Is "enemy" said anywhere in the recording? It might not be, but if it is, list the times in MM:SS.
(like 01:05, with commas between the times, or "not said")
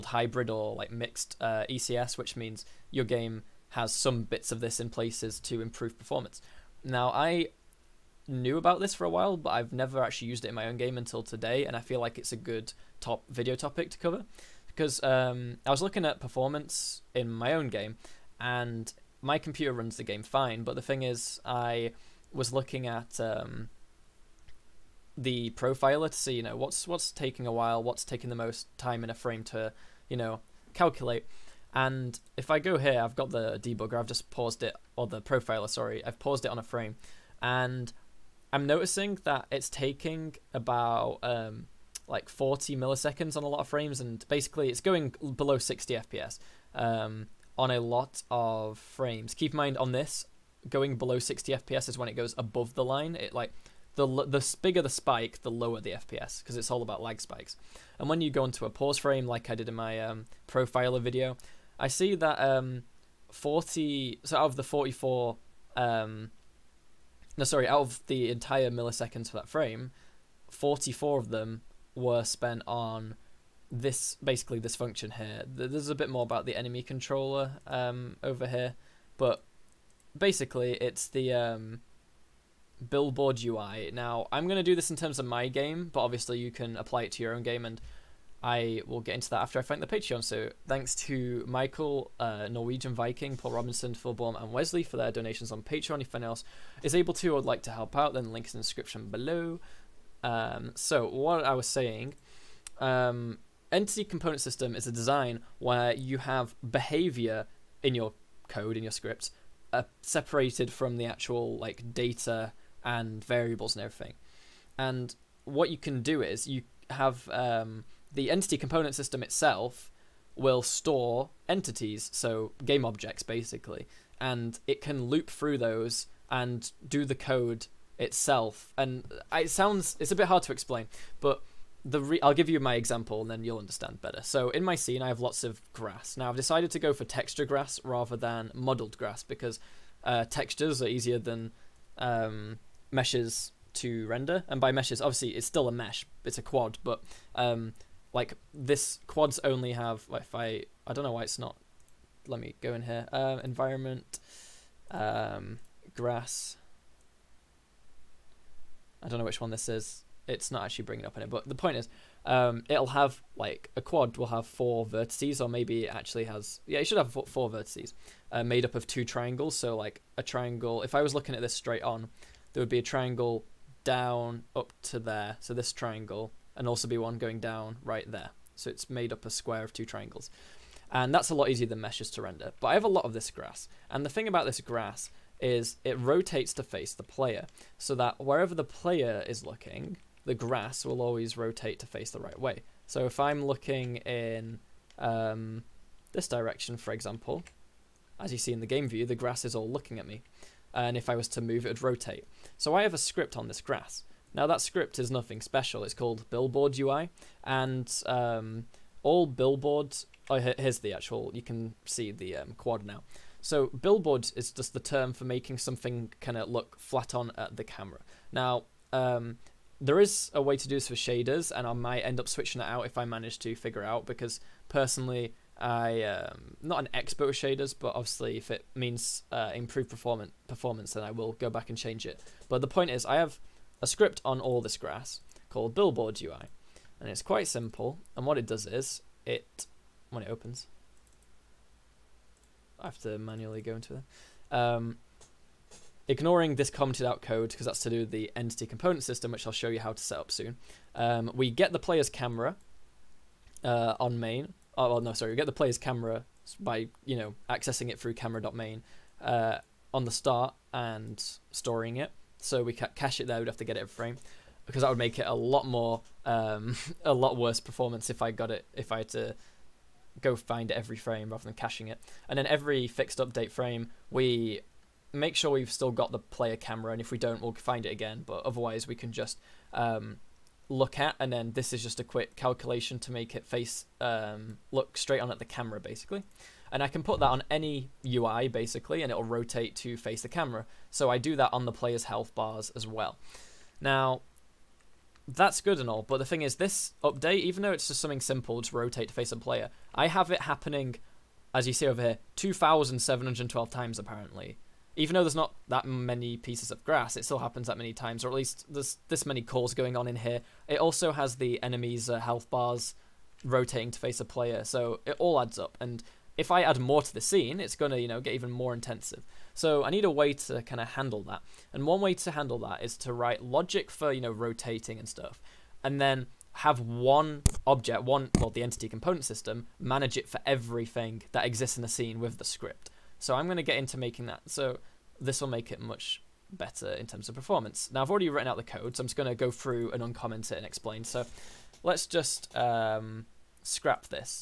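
01:16, 05:11.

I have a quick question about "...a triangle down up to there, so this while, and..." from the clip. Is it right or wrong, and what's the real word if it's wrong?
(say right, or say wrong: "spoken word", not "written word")
wrong: "triangle", not "while".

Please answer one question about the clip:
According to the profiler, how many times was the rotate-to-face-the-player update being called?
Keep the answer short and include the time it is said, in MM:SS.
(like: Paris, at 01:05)
2712, at 05:02.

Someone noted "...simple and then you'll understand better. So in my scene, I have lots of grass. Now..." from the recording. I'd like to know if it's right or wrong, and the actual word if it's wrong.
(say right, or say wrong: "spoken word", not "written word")
wrong: "example", not "simple".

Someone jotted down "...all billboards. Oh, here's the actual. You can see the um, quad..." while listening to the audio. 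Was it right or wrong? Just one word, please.
right.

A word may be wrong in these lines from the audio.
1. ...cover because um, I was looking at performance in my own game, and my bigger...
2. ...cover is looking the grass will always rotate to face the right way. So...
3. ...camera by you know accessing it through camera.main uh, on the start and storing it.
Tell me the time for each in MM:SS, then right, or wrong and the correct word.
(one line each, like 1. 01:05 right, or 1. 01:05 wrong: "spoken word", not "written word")
1. 00:13 wrong: "computer", not "bigger"
2. 03:08 wrong: "player", not "cover"
3. 04:15 right.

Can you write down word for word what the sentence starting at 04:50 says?
So I do that on the player's health bars as well.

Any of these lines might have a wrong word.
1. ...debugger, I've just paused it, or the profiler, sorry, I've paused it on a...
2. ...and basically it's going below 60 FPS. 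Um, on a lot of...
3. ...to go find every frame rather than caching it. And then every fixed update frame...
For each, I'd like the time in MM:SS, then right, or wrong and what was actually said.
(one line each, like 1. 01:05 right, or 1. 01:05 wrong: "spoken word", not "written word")
1. 00:33 right
2. 00:44 right
3. 04:29 right.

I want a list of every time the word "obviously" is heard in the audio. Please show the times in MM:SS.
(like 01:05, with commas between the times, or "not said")
01:26, 02:25, 03:47.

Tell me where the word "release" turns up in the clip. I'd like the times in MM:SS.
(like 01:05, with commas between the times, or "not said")
not said.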